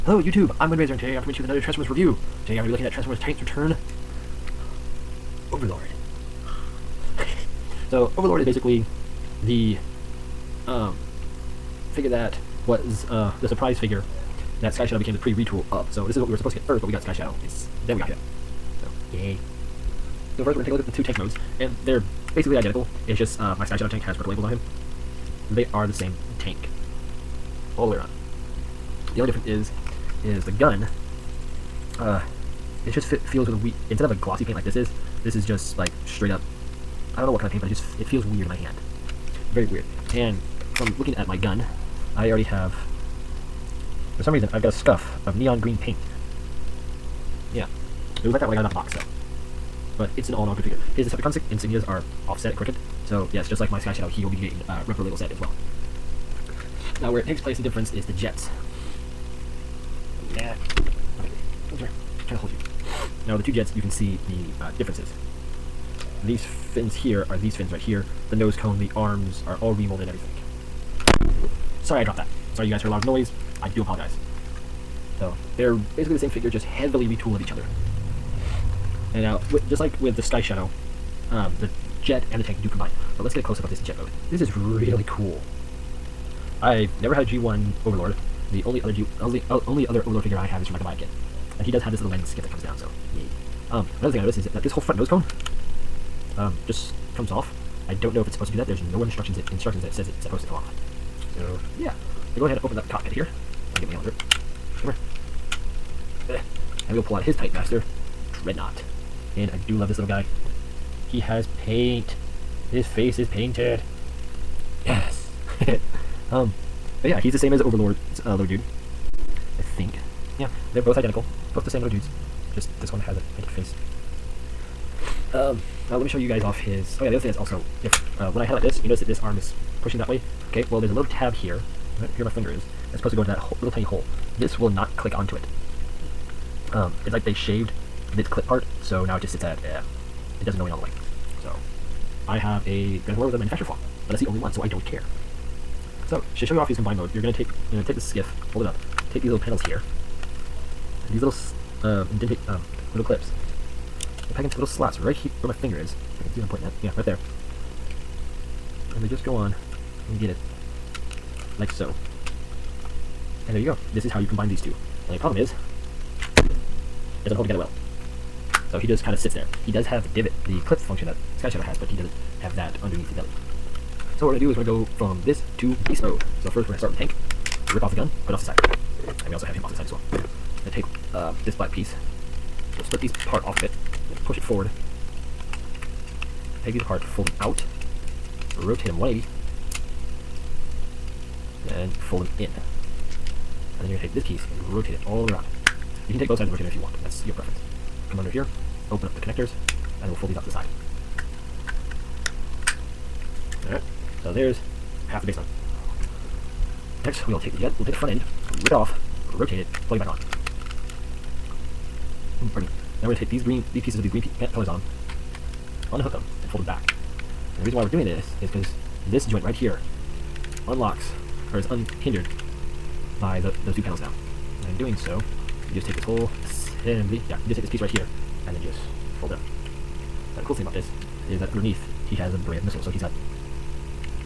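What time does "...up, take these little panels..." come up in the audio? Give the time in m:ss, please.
2:28.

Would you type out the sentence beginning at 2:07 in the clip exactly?
Oh yeah, the other thing that's also different.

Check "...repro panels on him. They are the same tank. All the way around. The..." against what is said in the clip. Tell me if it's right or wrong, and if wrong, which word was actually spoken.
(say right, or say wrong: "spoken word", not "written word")
wrong: "labels", not "panels".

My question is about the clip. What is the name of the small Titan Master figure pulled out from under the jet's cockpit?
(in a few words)
Dreadnought.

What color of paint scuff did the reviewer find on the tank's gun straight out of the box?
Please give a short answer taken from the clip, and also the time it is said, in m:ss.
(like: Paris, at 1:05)
neon green, at 0:45.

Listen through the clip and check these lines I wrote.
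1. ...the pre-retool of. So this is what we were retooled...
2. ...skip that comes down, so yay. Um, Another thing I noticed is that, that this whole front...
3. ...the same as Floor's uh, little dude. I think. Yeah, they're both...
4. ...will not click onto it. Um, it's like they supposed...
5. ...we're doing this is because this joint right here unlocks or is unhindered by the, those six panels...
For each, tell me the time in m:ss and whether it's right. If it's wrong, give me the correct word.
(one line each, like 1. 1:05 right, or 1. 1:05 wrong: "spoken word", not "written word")
1. 0:15 wrong: "supposed", not "retooled"
2. 1:32 right
3. 1:57 wrong: "Overlord", not "Floor"
4. 2:14 wrong: "shaved", not "supposed"
5. 3:37 wrong: "two", not "six".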